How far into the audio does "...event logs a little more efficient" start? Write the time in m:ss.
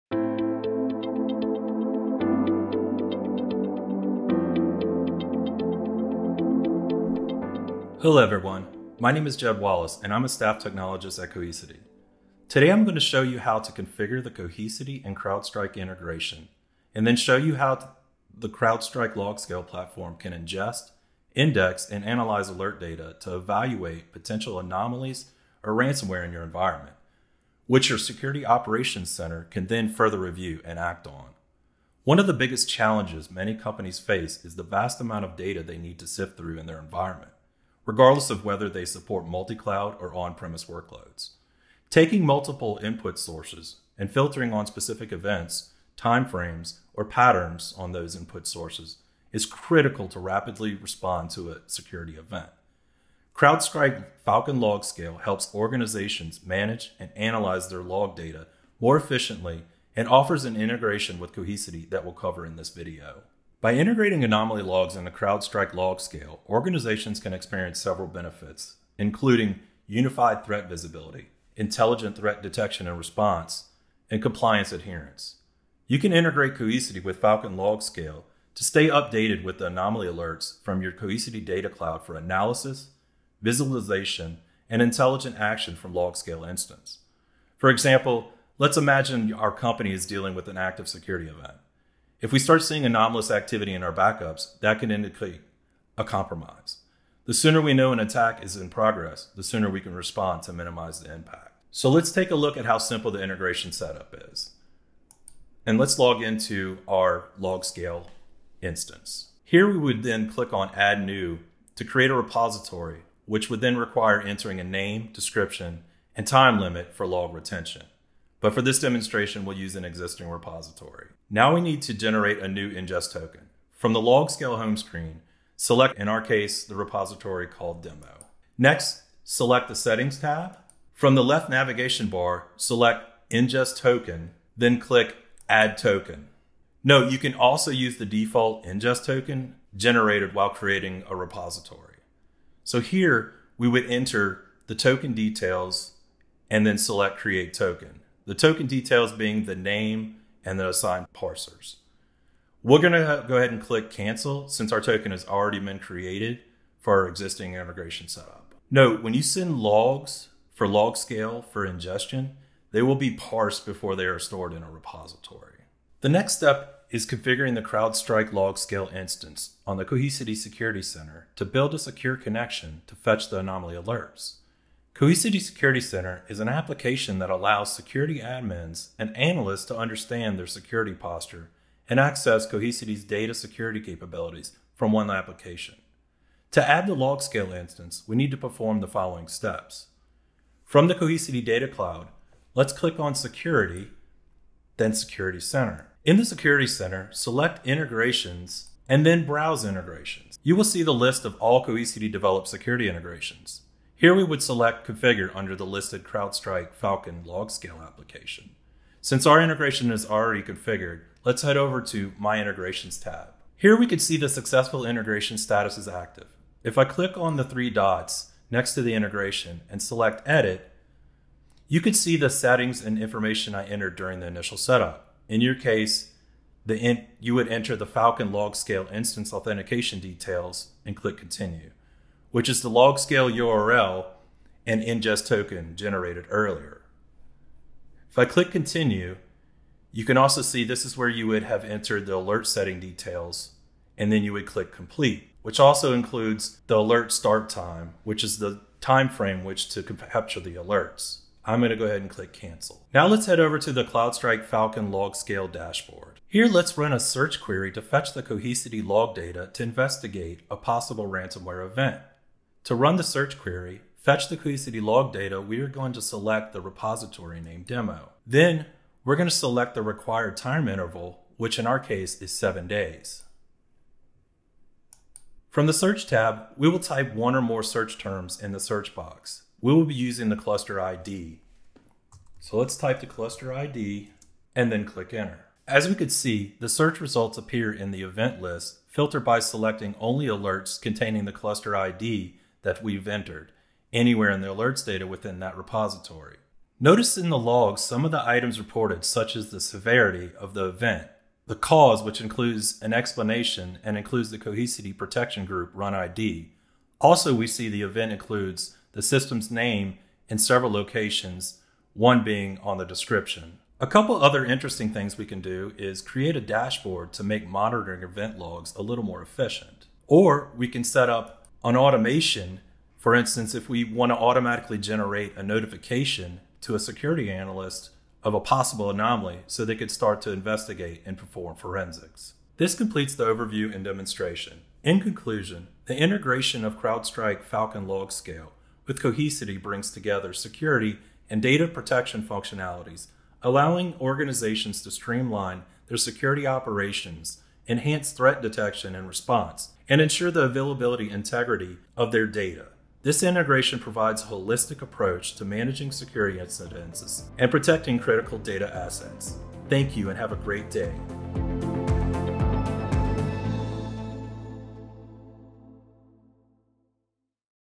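5:18.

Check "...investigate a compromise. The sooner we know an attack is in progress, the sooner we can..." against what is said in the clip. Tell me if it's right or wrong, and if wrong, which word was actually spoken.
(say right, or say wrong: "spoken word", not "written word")
wrong: "indicate", not "investigate".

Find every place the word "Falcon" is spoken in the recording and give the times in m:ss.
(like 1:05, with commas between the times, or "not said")
0:54, 1:17, 3:26, 3:47, 4:14, 5:37.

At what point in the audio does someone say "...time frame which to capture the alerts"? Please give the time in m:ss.
4:08.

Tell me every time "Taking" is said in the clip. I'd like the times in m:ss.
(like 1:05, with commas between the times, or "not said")
0:41.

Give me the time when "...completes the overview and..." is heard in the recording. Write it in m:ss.
5:32.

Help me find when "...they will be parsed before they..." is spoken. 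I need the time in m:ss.
2:42.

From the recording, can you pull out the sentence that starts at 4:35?
From the search tab, we will type one or more search terms in the search box.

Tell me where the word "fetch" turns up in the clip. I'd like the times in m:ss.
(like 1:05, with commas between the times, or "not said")
2:52, 4:17, 4:23.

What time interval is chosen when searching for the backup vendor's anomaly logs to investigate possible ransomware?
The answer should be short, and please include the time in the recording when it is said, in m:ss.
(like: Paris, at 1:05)
7 days, at 4:32.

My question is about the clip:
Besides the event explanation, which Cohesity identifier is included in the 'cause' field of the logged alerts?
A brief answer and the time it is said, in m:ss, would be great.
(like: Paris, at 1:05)
Protection Group run ID, at 5:04.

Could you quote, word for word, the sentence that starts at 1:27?
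For example, let's imagine our company is dealing with an active security event.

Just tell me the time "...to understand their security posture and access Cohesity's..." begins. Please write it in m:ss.
2:59.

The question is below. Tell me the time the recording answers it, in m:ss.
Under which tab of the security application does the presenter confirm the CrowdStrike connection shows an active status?
3:32.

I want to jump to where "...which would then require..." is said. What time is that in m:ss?
1:53.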